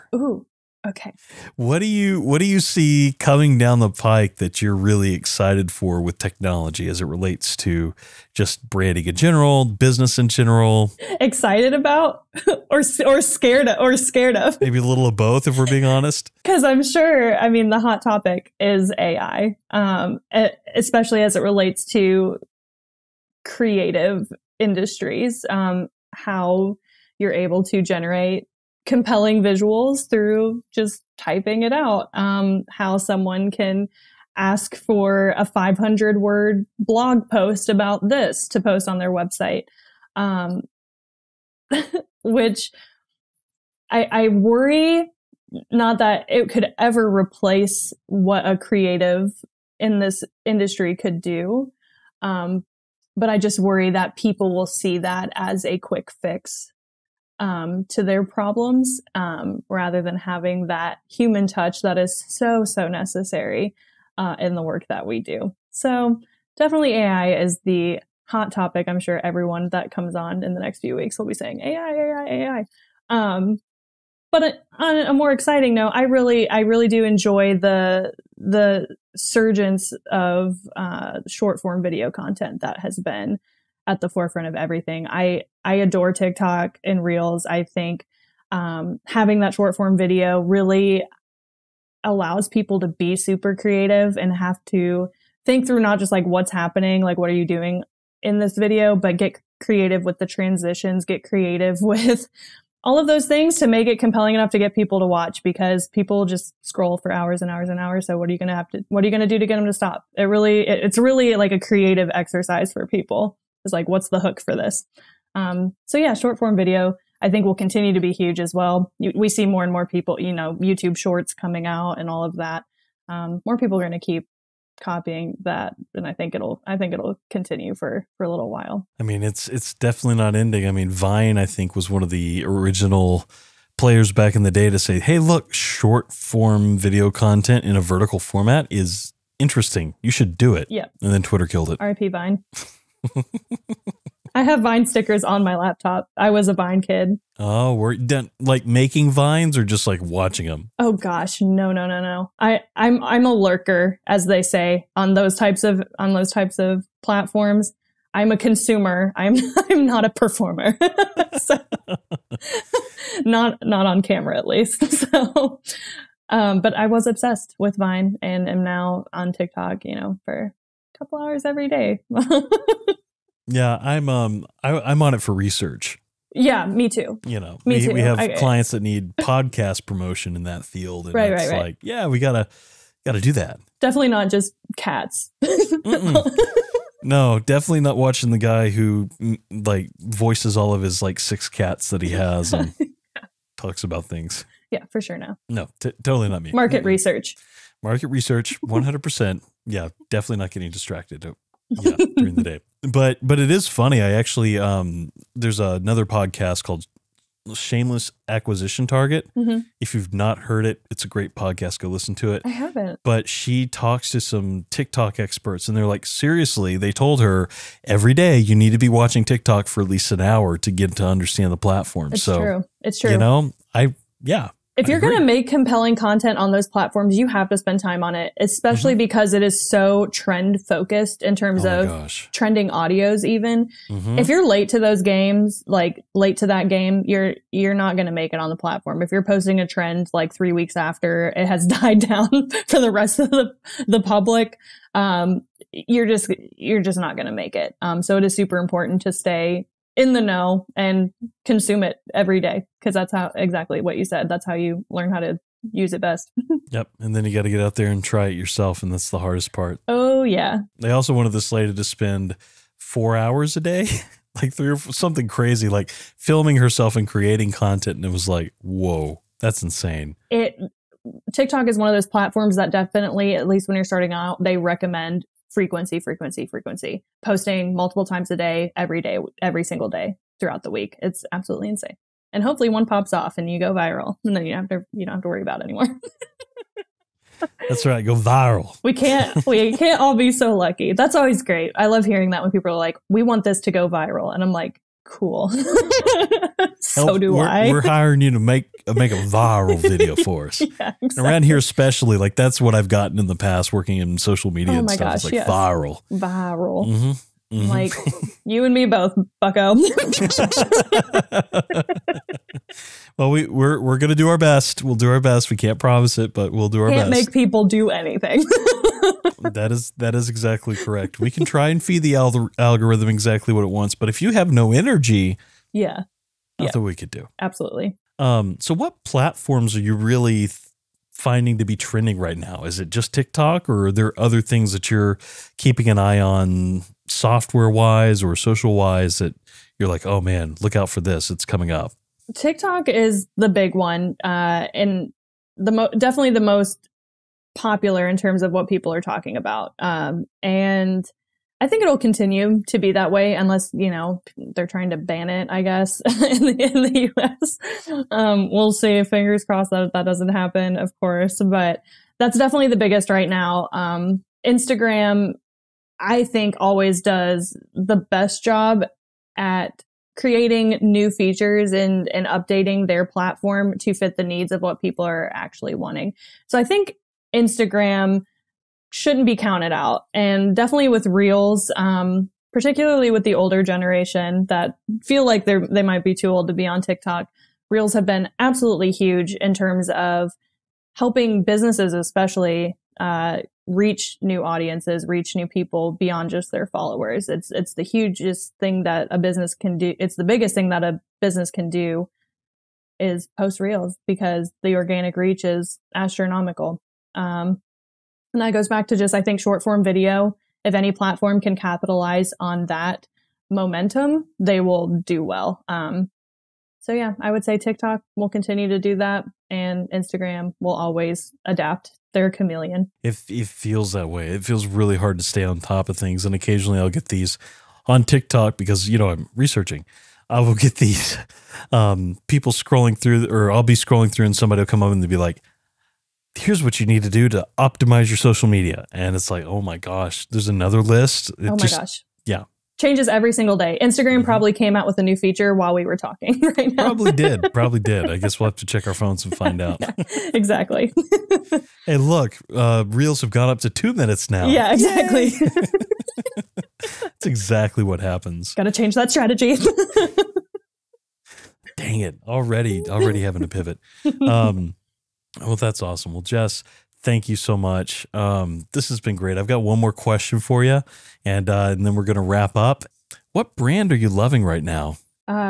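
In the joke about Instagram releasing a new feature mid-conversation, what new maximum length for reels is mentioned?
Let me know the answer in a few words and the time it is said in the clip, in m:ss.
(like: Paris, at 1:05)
2 minutes, at 7:33.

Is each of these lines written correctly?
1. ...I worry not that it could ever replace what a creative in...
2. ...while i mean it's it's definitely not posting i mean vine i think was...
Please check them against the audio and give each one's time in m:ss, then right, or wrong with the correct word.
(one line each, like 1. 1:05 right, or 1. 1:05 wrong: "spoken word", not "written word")
1. 0:44 right
2. 2:08 wrong: "ending", not "posting".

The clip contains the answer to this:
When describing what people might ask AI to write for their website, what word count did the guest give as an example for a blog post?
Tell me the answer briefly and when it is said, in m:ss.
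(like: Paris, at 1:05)
500, at 0:35.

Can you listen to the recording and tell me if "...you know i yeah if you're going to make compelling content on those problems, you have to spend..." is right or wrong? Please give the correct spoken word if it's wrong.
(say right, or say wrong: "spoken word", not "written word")
wrong: "platforms", not "problems".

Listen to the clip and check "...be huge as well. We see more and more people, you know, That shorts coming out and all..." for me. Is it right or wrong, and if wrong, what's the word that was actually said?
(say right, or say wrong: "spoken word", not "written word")
wrong: "YouTube", not "That".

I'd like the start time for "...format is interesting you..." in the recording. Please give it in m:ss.
2:18.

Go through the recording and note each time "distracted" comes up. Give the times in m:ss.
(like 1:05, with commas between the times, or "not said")
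3:20.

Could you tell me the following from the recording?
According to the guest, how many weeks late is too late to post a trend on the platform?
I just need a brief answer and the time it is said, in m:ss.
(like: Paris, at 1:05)
3 weeks, at 4:00.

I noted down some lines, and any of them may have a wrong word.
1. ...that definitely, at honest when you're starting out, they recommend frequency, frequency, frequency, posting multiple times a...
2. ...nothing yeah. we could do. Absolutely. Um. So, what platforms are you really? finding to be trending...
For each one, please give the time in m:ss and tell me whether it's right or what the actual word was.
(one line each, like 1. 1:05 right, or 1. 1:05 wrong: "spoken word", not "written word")
1. 4:32 wrong: "least", not "honest"
2. 5:26 right.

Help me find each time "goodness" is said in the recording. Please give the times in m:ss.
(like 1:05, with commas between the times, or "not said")
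not said.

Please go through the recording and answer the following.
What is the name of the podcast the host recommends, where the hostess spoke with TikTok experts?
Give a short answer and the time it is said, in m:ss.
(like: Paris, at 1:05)
Shameless Acquisition Target, at 3:27.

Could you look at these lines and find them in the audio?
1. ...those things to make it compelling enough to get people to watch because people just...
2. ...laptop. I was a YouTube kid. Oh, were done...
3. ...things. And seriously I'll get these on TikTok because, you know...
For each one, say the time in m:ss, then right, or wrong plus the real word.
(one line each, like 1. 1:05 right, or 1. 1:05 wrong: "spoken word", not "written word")
1. 1:43 right
2. 2:25 wrong: "Vine", not "YouTube"
3. 7:05 wrong: "occasionally", not "seriously".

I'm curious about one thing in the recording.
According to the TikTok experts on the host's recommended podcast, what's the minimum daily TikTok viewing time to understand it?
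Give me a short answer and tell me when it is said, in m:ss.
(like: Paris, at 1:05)
1 hour, at 3:39.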